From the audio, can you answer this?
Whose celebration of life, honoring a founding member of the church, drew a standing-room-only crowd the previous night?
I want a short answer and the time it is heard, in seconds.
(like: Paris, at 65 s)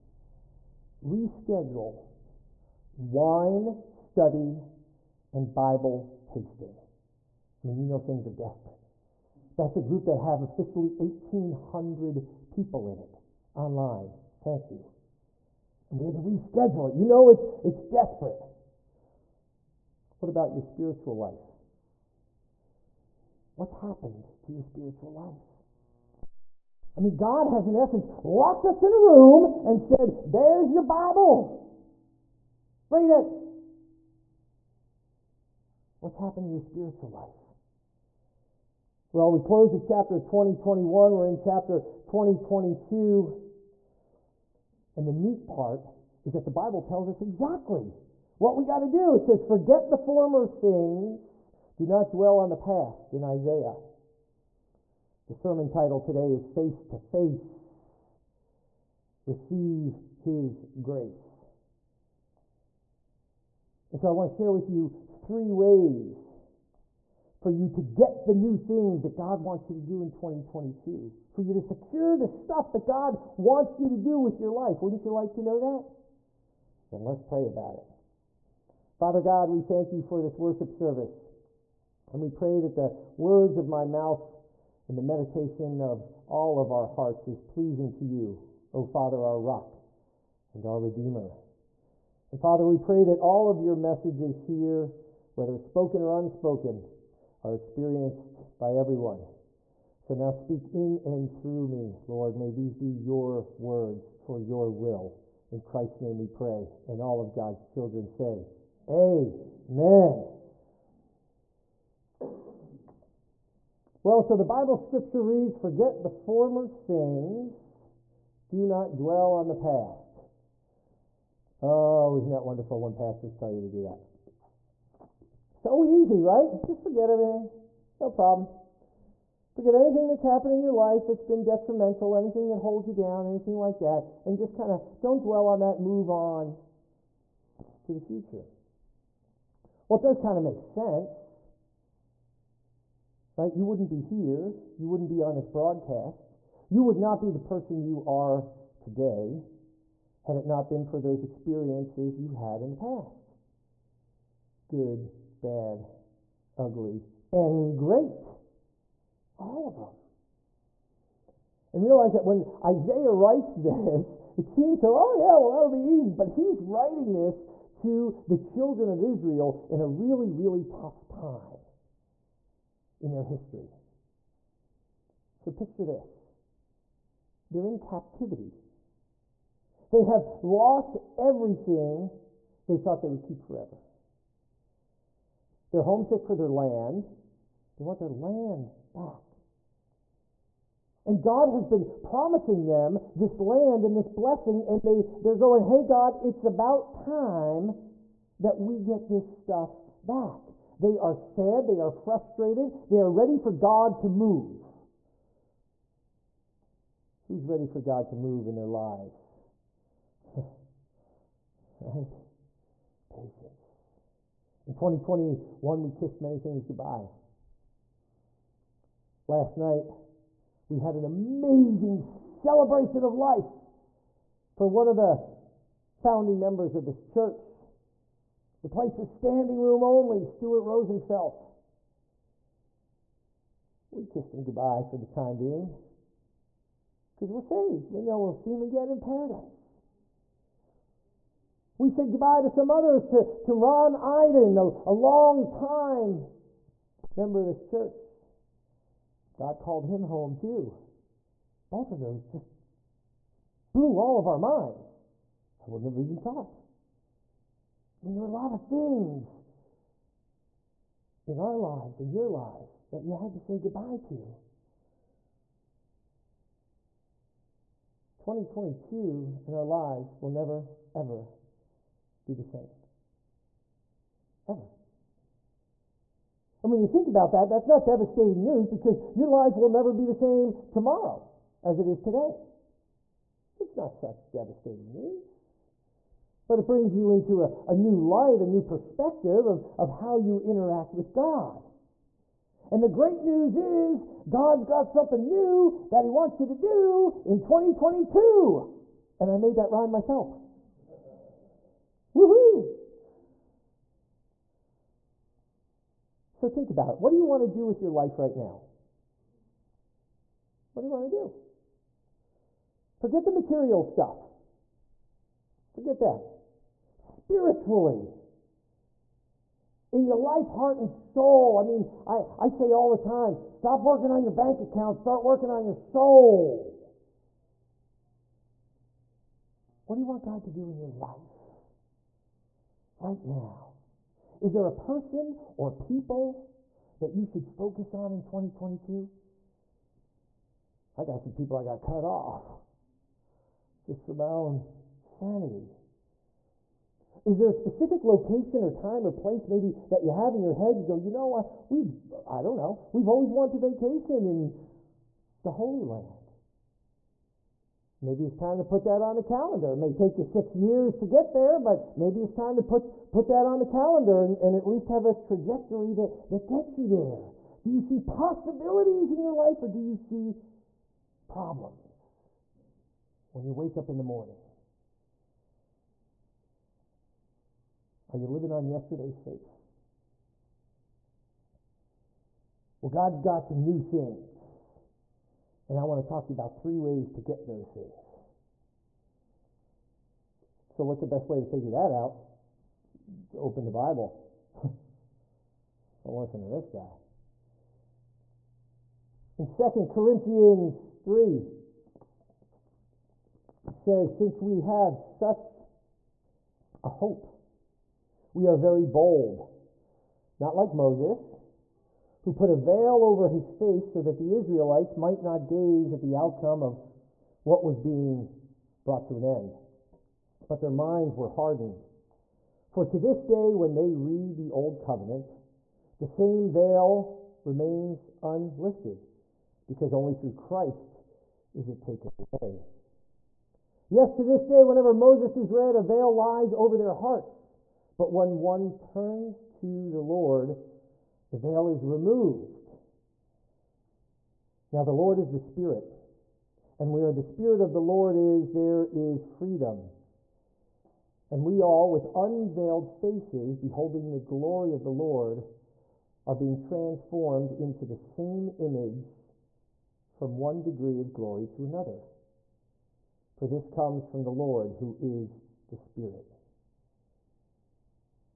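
Stuart Rosenfeld, at 230 s.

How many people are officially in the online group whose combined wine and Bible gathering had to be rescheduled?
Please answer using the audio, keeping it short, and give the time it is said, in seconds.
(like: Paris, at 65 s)
1,800, at 10 s.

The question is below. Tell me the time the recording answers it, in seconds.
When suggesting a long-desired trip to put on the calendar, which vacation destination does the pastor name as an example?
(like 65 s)
355 s.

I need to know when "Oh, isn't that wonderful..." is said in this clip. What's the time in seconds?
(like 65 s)
121 s.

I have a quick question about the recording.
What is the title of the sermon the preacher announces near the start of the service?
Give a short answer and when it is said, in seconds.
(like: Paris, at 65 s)
Face to Face Receive His Grace, at 56 s.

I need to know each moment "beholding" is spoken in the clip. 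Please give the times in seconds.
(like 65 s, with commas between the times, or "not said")
453 s.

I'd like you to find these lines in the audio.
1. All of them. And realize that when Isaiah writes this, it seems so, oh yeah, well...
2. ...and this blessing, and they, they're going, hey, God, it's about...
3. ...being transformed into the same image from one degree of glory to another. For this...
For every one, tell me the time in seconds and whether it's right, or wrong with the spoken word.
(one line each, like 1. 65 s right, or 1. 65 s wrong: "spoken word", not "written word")
1. 159 s right
2. 193 s right
3. 456 s right.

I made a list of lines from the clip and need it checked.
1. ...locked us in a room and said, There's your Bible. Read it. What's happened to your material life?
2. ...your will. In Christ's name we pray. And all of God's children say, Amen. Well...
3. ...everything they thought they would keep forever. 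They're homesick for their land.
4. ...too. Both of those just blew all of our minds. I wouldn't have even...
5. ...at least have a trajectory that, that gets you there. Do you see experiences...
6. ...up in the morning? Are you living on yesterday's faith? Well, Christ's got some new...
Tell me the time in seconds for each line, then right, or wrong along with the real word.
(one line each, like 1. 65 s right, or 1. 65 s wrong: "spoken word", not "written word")
1. 28 s wrong: "spiritual", not "material"
2. 104 s right
3. 181 s right
4. 250 s right
5. 364 s wrong: "possibilities", not "experiences"
6. 373 s wrong: "God", not "Christ".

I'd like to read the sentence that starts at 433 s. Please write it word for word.
Yes, to this day, whenever Moses is read, a veil lies over their hearts.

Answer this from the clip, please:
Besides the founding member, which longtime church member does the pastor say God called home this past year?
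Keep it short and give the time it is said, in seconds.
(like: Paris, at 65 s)
Ron Iden, at 243 s.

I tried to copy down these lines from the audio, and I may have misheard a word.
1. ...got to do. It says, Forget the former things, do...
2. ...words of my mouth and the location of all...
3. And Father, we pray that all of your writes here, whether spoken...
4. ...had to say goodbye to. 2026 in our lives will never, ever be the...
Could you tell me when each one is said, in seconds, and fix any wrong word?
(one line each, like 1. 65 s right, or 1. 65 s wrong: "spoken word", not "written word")
1. 48 s right
2. 83 s wrong: "meditation", not "location"
3. 92 s wrong: "messages", not "writes"
4. 263 s wrong: "2022", not "2026".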